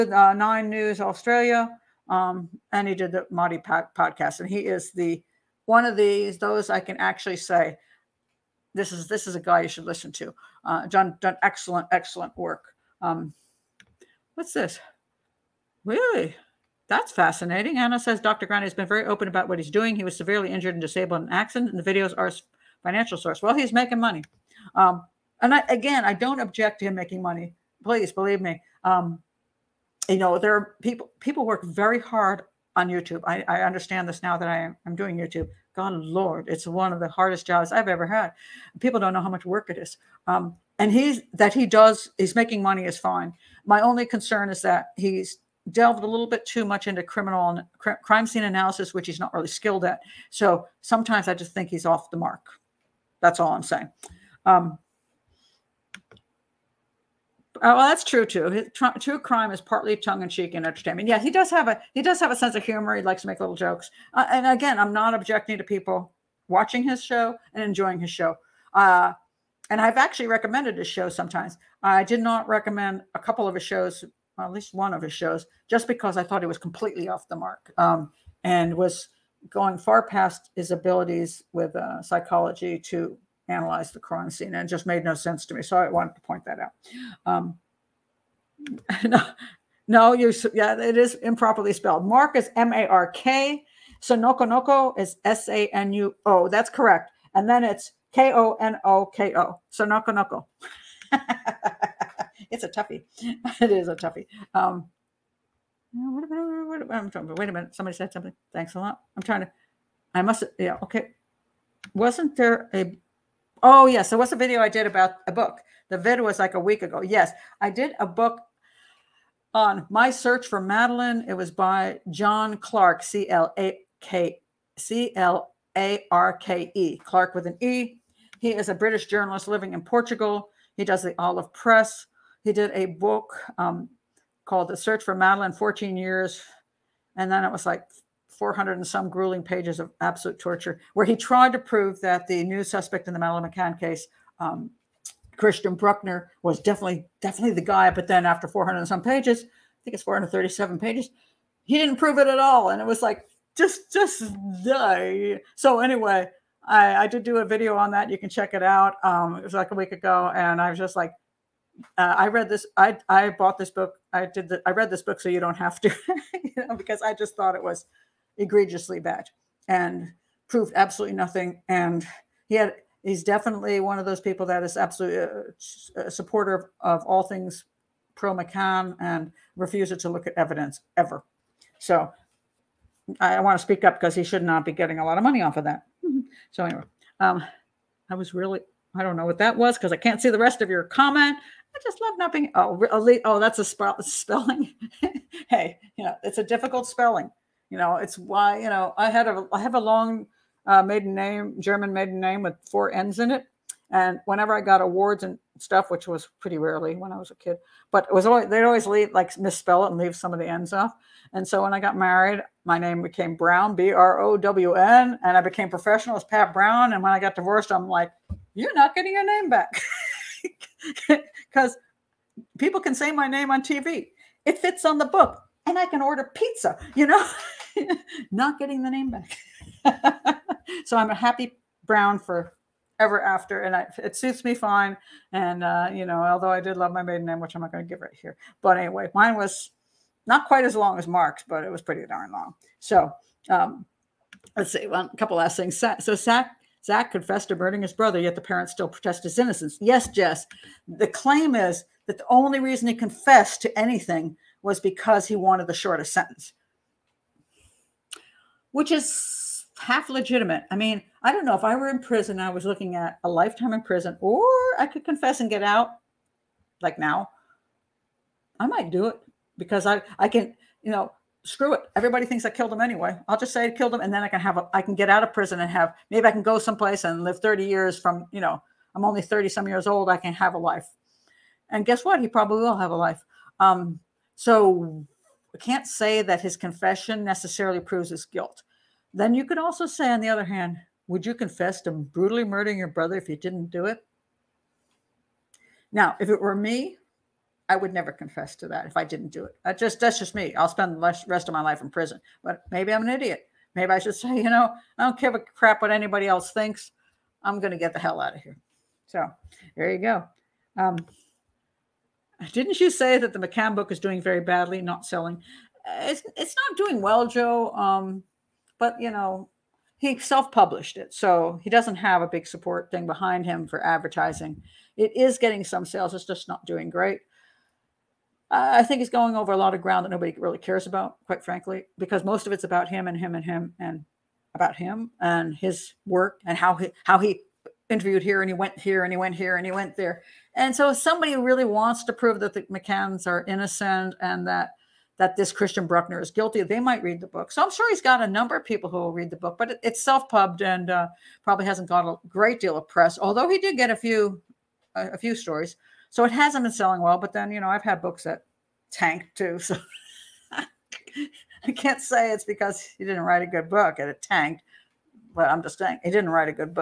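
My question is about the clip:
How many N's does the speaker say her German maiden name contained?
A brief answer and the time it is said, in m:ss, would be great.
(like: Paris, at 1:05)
4, at 3:22.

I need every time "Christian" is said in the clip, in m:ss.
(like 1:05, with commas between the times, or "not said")
2:25, 5:45.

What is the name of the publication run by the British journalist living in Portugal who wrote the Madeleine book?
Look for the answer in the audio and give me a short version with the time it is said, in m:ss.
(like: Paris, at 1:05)
The Olive Press, at 2:11.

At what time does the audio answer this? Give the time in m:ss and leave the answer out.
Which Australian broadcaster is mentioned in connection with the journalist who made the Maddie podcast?
0:00.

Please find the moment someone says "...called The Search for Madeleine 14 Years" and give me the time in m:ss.
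2:14.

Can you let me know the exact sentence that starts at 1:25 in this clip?
So I wanted to point that out.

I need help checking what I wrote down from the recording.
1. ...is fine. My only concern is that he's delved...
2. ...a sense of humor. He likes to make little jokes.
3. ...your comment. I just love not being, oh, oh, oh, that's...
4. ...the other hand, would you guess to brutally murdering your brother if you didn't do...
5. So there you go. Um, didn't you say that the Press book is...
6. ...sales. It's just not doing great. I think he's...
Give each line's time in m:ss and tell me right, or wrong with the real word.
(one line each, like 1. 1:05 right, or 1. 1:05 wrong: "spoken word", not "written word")
1. 0:42 right
2. 1:02 right
3. 3:10 right
4. 4:50 wrong: "confess", not "guess"
5. 5:09 wrong: "McCann", not "Press"
6. 5:25 right.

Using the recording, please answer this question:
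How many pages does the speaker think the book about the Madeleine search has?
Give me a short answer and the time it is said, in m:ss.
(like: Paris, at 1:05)
437, at 2:30.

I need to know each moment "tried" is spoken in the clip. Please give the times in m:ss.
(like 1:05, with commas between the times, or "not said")
2:21.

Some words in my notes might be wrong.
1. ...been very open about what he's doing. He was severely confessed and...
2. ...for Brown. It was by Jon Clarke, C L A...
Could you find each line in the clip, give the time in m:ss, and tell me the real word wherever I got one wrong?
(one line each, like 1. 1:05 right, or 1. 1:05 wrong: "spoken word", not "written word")
1. 0:18 wrong: "injured", not "confessed"
2. 2:00 wrong: "Madeleine", not "Brown".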